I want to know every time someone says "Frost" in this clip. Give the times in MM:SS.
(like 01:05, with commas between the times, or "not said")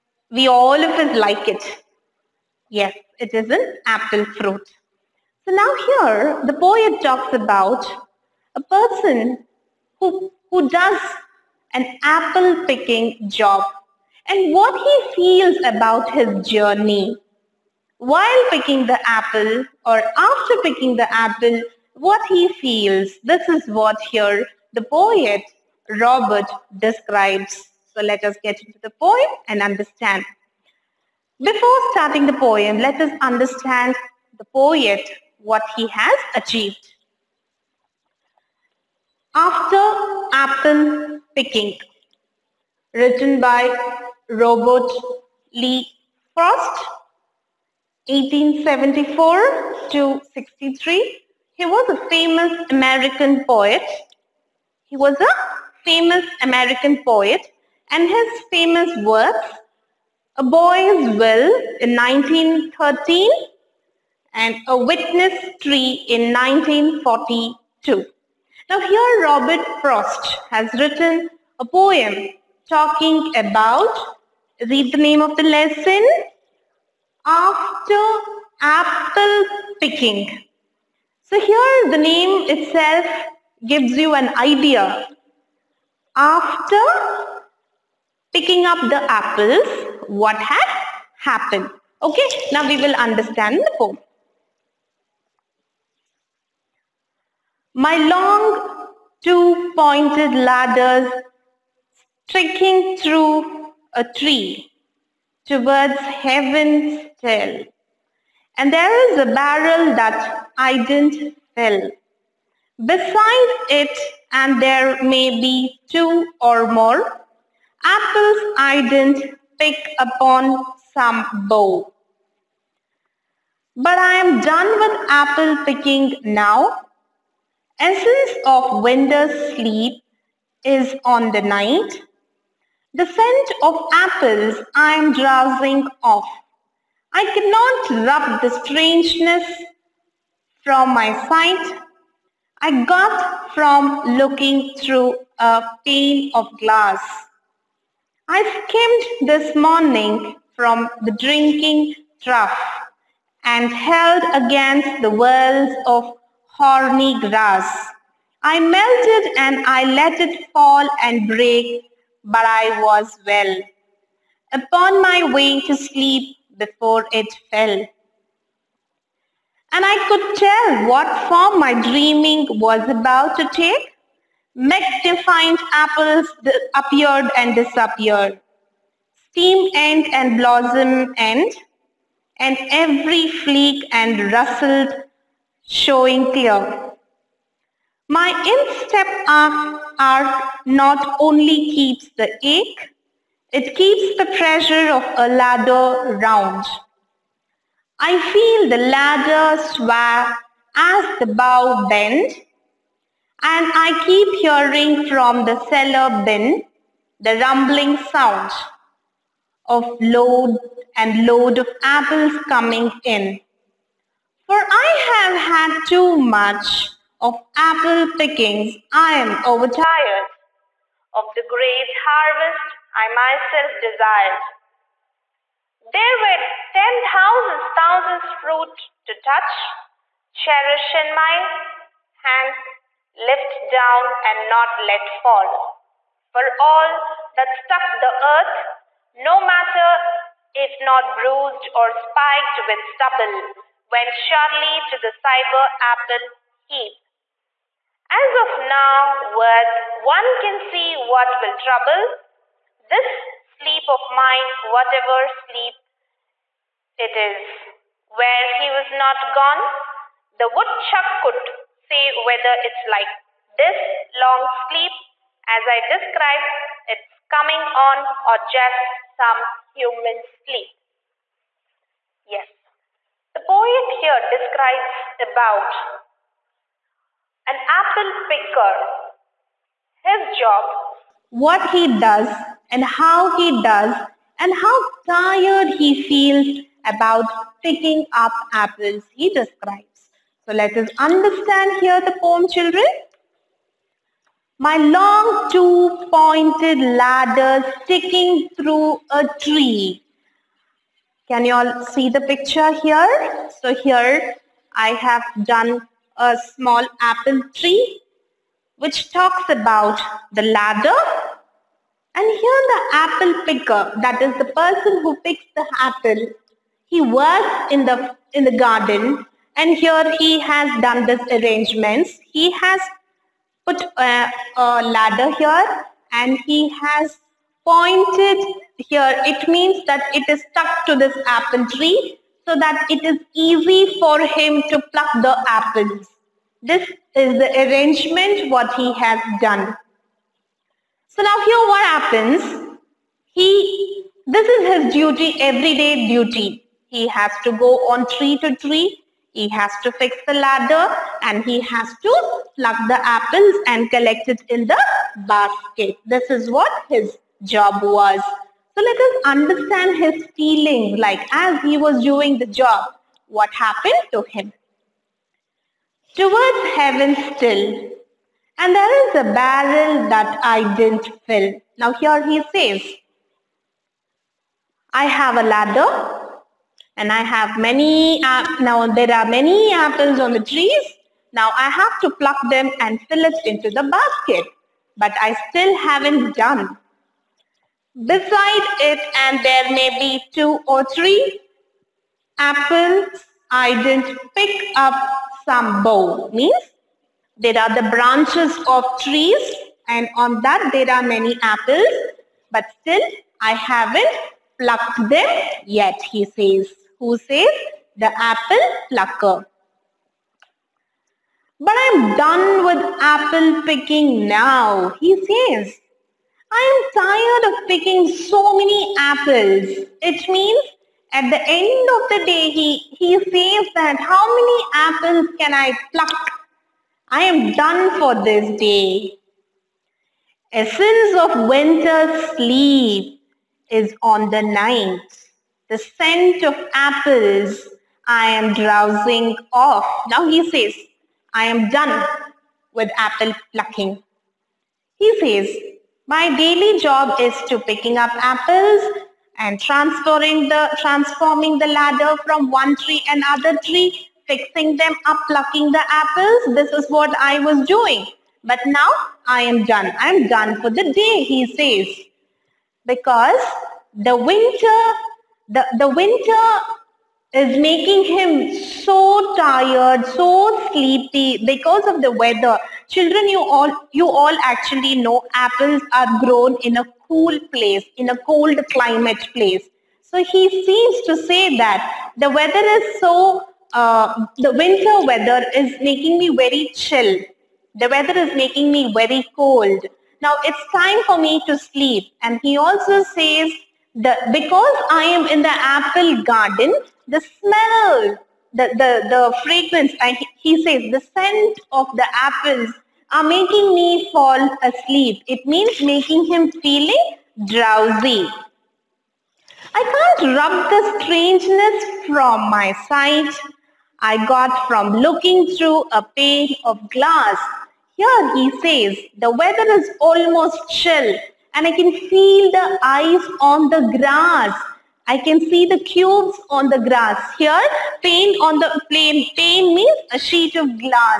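00:46, 01:09.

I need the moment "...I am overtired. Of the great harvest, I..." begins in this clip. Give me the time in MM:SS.
03:38.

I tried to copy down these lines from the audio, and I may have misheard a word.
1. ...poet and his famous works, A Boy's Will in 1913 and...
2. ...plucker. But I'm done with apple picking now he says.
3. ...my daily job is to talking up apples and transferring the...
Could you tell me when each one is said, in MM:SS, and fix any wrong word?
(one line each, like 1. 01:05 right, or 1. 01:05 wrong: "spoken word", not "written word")
1. 00:57 right
2. 06:48 right
3. 07:26 wrong: "picking", not "talking".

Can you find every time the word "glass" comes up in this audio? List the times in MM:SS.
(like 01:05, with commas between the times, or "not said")
02:26, 08:36.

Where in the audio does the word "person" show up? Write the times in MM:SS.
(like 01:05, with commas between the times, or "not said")
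00:08, 05:14.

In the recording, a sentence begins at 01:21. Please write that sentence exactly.
So here the name itself gives you an idea.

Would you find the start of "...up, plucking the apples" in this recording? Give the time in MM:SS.
07:35.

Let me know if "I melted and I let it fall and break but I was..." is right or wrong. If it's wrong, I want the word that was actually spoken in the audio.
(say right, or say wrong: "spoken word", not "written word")
right.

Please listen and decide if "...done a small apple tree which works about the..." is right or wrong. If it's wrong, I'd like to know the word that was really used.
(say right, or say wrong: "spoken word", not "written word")
wrong: "talks", not "works".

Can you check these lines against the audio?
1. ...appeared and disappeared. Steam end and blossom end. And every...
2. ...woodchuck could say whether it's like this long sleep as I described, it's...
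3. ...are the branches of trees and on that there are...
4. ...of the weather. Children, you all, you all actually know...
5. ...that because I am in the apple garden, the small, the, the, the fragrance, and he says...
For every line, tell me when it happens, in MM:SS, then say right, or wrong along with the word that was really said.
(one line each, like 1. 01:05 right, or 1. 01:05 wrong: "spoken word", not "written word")
1. 02:56 right
2. 04:20 right
3. 06:37 right
4. 07:51 right
5. 08:13 wrong: "smell", not "small".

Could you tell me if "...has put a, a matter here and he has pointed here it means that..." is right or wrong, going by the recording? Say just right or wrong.
wrong.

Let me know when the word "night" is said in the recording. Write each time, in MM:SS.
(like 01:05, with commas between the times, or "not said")
02:11, 07:14.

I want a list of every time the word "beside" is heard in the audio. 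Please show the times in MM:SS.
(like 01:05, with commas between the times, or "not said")
01:52, 06:28.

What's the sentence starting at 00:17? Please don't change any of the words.
While picking the apple or after picking the apple, what he feels.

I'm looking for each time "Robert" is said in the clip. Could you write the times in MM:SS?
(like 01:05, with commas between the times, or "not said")
00:25, 00:44, 01:09.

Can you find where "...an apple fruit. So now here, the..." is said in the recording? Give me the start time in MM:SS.
00:03.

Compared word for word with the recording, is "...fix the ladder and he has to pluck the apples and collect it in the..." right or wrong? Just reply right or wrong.
right.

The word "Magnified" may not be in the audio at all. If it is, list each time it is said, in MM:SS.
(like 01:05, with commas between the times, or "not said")
02:54.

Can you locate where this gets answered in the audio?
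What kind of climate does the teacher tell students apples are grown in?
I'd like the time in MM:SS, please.
07:58.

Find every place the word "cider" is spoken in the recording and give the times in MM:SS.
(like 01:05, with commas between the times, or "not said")
04:05.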